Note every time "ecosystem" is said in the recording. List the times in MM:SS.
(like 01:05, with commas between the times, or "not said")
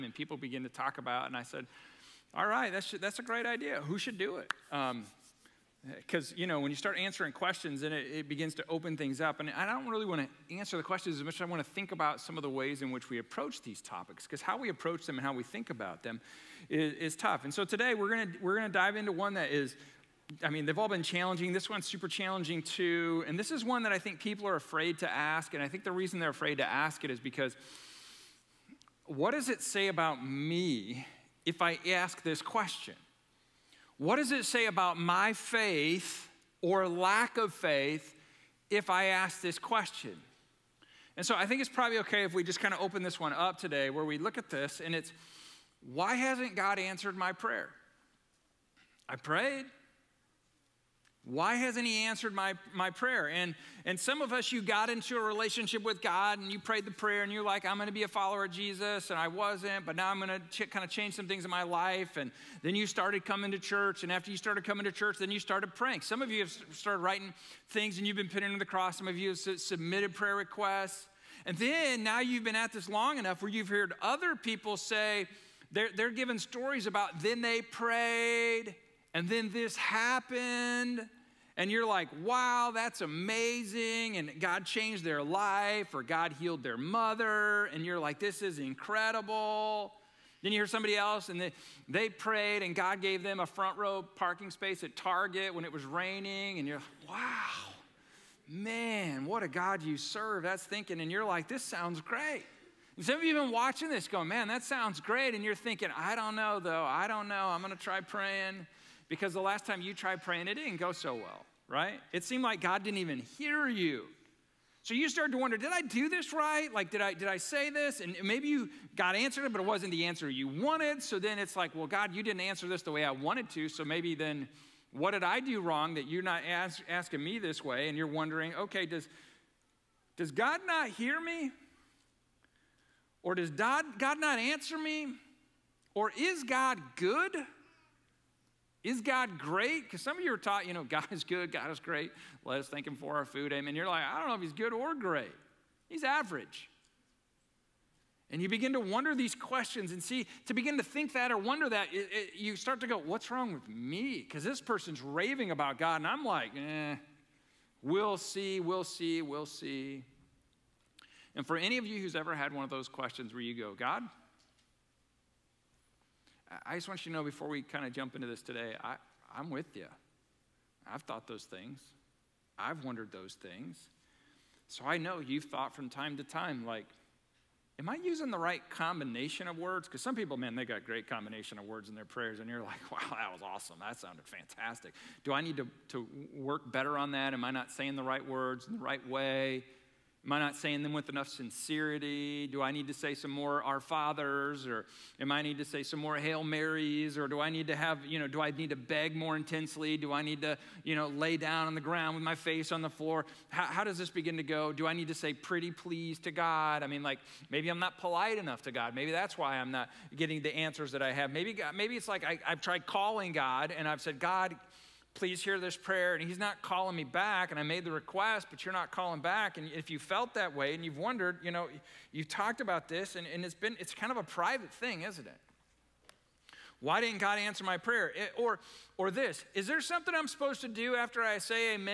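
not said.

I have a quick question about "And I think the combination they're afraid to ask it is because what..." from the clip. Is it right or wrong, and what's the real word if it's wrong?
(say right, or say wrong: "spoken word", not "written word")
wrong: "reason", not "combination".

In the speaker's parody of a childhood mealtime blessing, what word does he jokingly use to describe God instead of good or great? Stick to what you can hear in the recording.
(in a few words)
Average.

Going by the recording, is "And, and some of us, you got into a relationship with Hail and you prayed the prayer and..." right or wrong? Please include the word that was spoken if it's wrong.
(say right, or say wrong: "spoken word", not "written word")
wrong: "God", not "Hail".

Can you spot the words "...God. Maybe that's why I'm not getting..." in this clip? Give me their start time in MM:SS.
03:28.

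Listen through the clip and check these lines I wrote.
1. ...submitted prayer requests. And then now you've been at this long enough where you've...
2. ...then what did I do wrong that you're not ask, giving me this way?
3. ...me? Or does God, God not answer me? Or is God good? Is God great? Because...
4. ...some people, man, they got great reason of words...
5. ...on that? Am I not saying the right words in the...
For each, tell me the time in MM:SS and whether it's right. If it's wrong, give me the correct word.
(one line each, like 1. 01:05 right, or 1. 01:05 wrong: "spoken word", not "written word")
1. 01:09 right
2. 02:04 wrong: "asking", not "giving"
3. 02:11 right
4. 03:00 wrong: "combination", not "reason"
5. 03:06 right.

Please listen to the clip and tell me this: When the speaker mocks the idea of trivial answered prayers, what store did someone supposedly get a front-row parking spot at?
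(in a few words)
Target.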